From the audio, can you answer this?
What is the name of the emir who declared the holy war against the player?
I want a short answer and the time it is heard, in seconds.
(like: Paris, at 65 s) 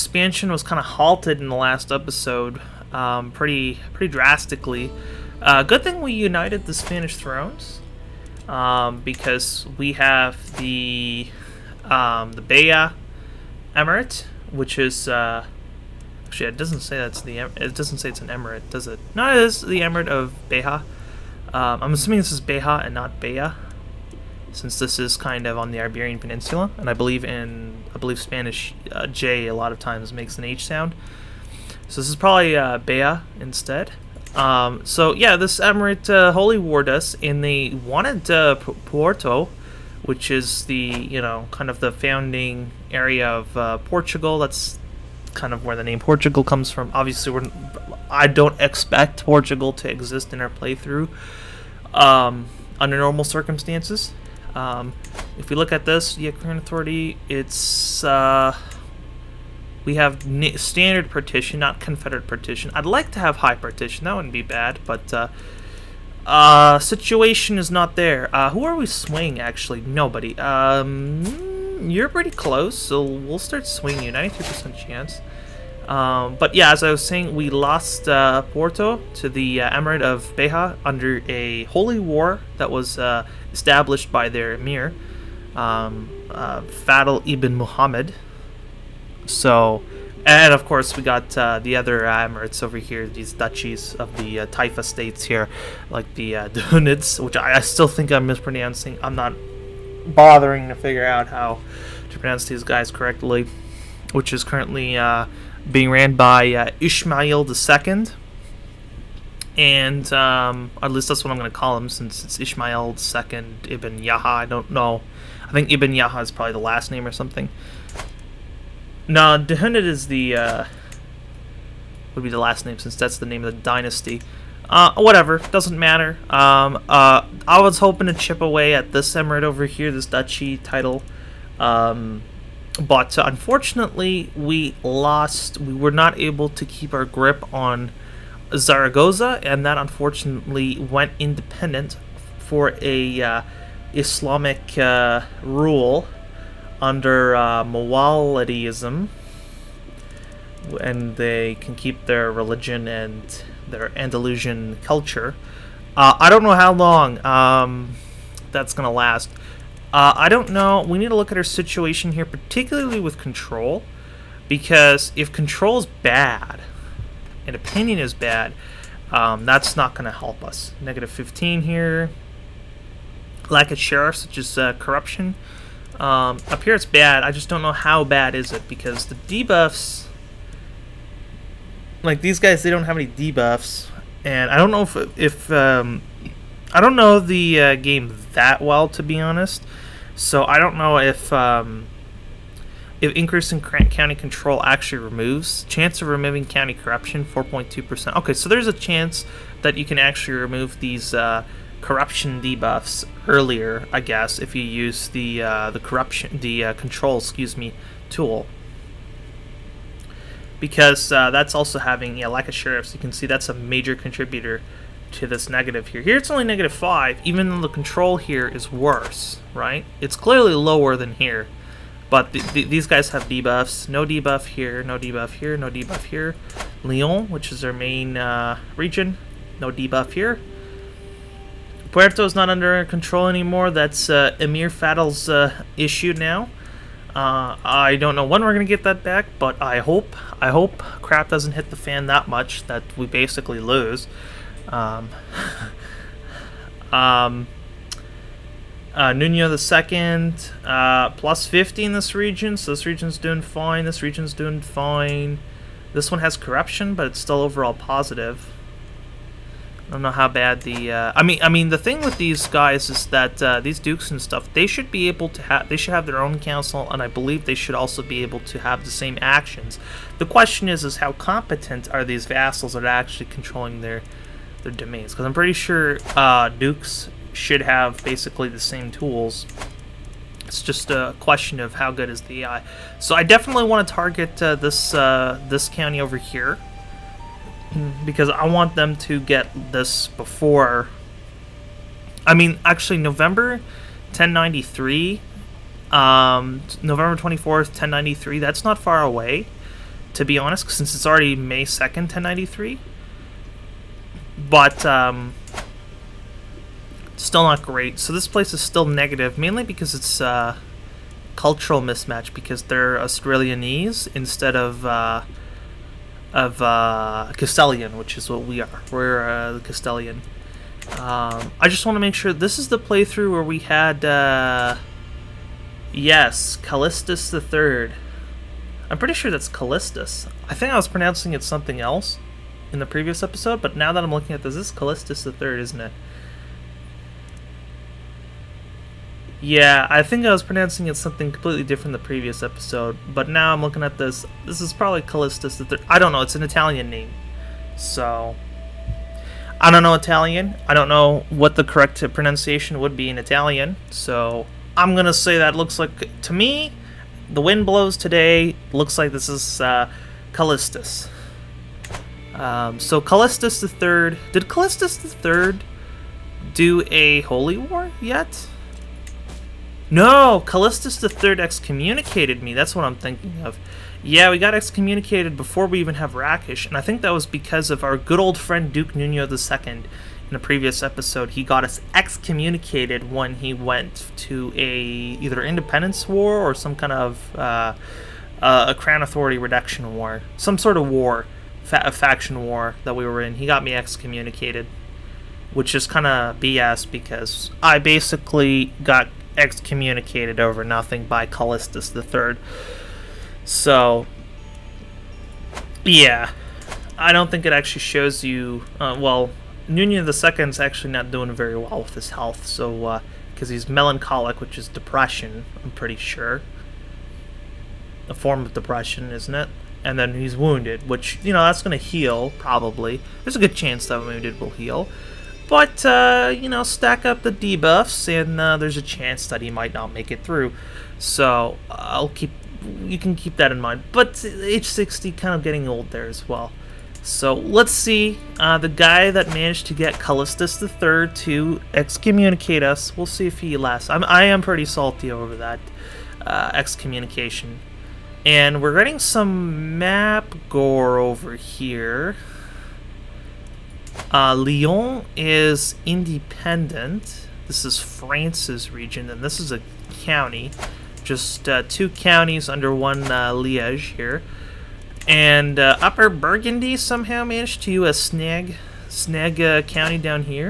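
Fadl ibn Muhammad, at 86 s.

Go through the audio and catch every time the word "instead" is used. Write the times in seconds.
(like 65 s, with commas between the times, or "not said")
33 s, 314 s.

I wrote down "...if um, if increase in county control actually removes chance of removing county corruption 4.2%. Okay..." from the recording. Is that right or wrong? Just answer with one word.
right.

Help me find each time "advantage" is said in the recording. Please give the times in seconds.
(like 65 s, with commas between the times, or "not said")
not said.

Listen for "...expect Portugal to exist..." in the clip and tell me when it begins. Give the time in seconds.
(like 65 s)
48 s.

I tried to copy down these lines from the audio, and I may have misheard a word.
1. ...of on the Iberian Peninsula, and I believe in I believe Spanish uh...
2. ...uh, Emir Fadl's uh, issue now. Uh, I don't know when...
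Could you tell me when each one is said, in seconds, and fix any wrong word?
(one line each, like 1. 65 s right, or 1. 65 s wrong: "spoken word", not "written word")
1. 25 s right
2. 234 s right.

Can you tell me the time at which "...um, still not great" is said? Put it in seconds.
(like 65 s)
304 s.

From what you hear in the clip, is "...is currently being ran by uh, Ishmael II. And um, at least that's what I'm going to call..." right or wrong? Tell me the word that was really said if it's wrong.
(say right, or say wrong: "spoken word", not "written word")
right.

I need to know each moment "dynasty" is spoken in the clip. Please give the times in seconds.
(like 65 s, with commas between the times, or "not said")
123 s.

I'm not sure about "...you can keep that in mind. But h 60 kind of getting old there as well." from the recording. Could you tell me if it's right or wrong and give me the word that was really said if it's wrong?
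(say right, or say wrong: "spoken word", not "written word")
right.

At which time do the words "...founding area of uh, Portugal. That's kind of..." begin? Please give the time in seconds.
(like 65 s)
41 s.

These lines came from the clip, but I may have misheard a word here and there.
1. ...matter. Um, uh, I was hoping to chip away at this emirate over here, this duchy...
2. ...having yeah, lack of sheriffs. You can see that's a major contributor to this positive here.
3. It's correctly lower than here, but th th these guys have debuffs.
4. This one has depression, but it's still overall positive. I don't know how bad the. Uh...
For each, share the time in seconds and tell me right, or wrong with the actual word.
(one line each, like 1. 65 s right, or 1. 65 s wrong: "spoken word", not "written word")
1. 125 s right
2. 211 s wrong: "negative", not "positive"
3. 220 s wrong: "clearly", not "correctly"
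4. 255 s wrong: "corruption", not "depression".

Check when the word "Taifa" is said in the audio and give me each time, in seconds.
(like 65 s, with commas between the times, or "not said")
94 s.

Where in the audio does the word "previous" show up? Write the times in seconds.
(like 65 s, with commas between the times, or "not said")
332 s, 341 s, 380 s.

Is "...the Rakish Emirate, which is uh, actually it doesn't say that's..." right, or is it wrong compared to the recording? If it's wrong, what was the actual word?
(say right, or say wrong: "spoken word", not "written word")
wrong: "Beya", not "Rakish".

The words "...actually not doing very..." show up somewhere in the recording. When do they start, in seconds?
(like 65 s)
410 s.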